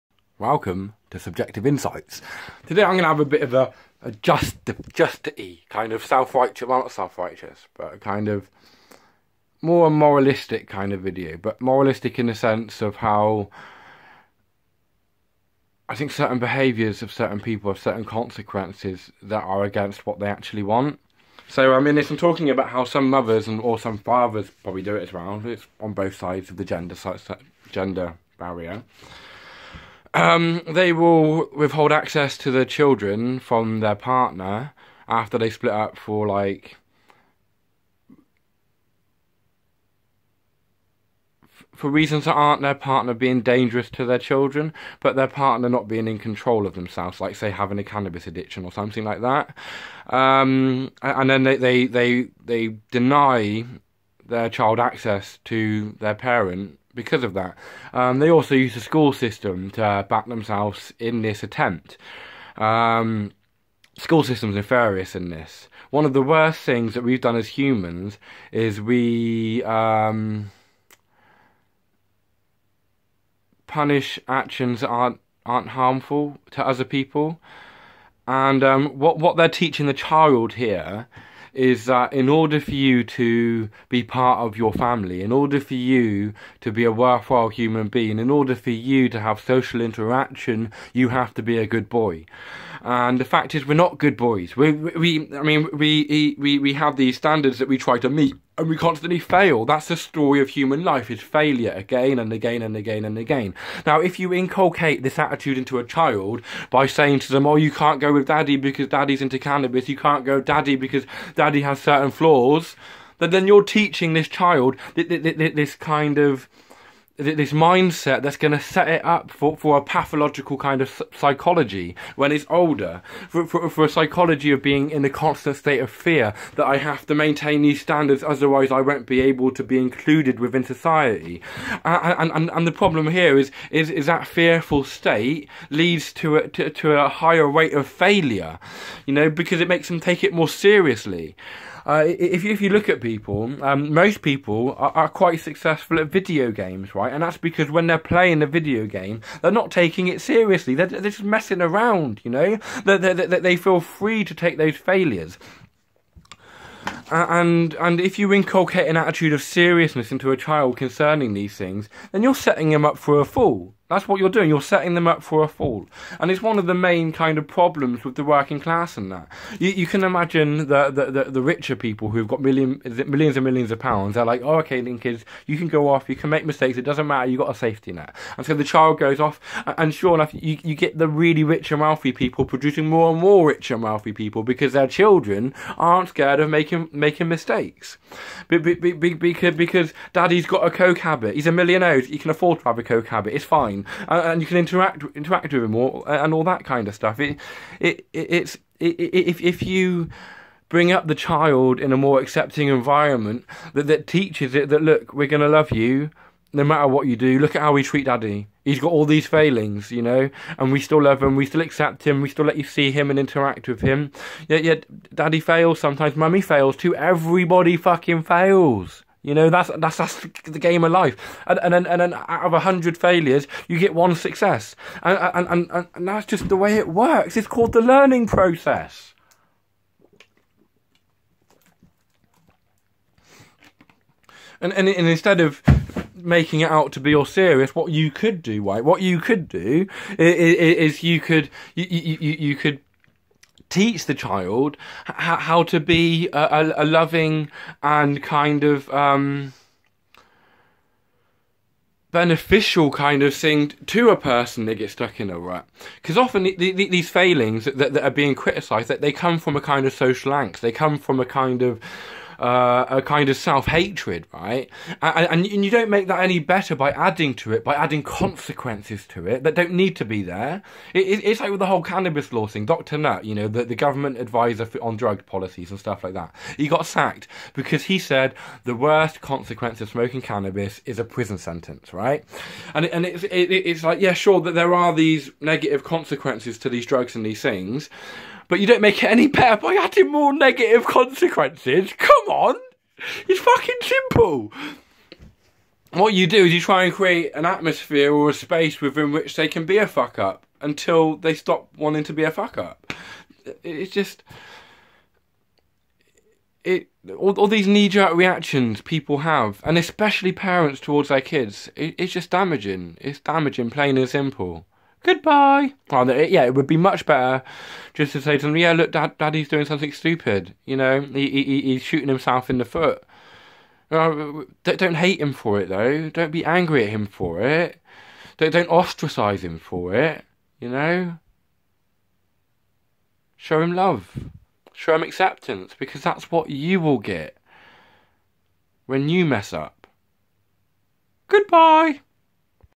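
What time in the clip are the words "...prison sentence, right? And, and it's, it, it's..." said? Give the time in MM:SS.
04:41.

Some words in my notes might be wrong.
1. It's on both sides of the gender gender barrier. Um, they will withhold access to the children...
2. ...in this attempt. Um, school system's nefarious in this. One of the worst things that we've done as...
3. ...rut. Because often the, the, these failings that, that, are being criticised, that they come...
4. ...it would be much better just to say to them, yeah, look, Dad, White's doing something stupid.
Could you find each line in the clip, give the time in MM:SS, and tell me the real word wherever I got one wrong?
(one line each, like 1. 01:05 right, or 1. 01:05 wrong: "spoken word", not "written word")
1. 00:25 right
2. 01:00 right
3. 04:15 right
4. 05:16 wrong: "Daddy", not "White".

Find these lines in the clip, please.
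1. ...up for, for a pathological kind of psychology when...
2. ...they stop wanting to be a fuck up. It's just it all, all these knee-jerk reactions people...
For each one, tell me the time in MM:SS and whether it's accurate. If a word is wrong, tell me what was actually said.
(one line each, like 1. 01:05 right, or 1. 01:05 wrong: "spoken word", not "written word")
1. 01:59 right
2. 05:01 right.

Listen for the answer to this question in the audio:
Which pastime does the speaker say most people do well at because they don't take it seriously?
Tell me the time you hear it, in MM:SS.
02:26.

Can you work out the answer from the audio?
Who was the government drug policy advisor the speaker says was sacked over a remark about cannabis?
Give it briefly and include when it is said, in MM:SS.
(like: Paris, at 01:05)
Dr. Nutt, at 04:32.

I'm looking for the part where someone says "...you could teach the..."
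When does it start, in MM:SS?
04:02.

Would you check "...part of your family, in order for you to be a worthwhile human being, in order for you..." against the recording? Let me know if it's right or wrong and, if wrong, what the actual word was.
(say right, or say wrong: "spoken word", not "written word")
right.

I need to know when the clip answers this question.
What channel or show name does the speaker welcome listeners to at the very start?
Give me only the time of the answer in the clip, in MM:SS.
00:01.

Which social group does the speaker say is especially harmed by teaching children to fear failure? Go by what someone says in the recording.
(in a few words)
working class.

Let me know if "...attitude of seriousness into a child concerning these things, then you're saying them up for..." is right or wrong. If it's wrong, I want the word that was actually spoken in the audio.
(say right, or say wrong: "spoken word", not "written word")
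wrong: "setting", not "saying".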